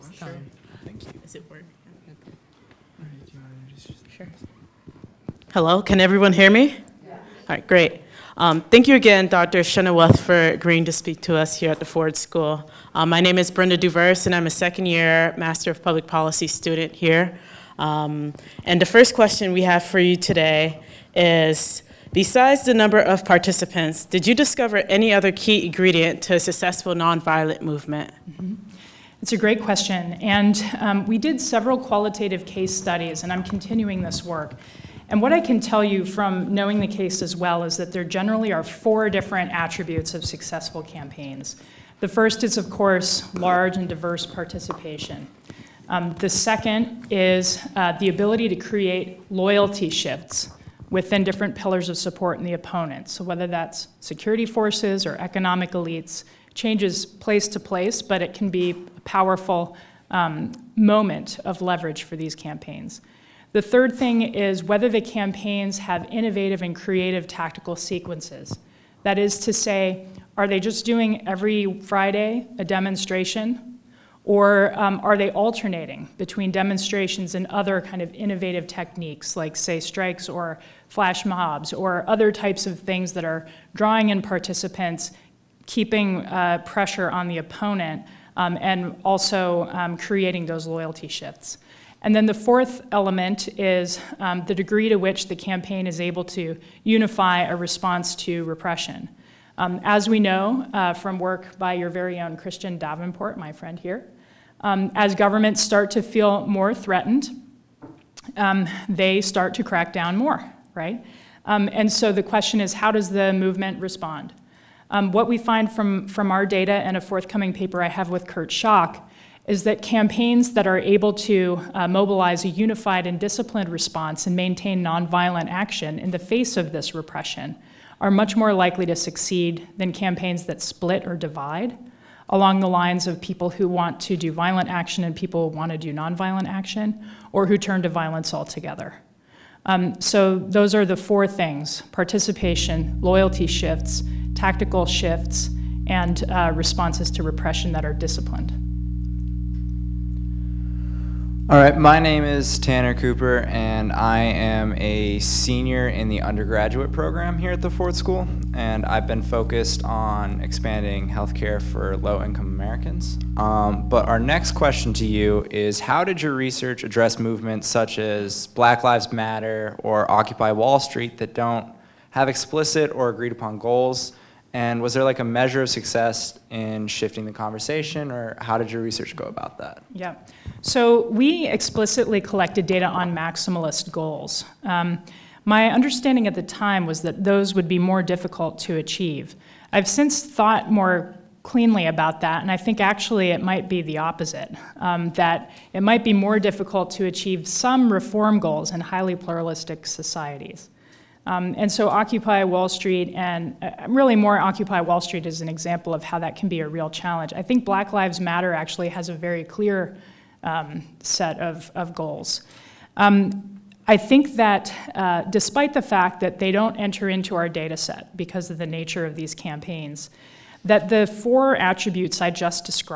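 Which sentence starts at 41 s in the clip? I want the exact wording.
The first is, of course, large and diverse participation.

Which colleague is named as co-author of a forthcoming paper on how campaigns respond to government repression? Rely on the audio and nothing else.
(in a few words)
Kurt Schock.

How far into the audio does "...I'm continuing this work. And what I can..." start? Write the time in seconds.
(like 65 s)
33 s.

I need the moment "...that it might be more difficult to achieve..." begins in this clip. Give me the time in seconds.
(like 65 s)
195 s.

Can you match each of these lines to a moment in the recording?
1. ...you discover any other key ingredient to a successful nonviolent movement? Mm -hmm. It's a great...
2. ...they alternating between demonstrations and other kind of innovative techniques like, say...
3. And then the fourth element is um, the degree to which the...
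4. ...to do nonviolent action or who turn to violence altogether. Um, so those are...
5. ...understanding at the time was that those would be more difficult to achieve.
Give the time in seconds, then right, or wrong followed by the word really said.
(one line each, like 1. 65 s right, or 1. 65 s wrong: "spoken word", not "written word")
1. 24 s right
2. 75 s right
3. 92 s right
4. 135 s right
5. 185 s right.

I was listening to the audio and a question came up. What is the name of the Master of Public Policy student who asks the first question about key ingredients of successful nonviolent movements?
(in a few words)
Brenda Duvers.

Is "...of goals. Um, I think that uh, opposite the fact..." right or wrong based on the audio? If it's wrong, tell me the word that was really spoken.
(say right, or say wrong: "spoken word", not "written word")
wrong: "despite", not "opposite".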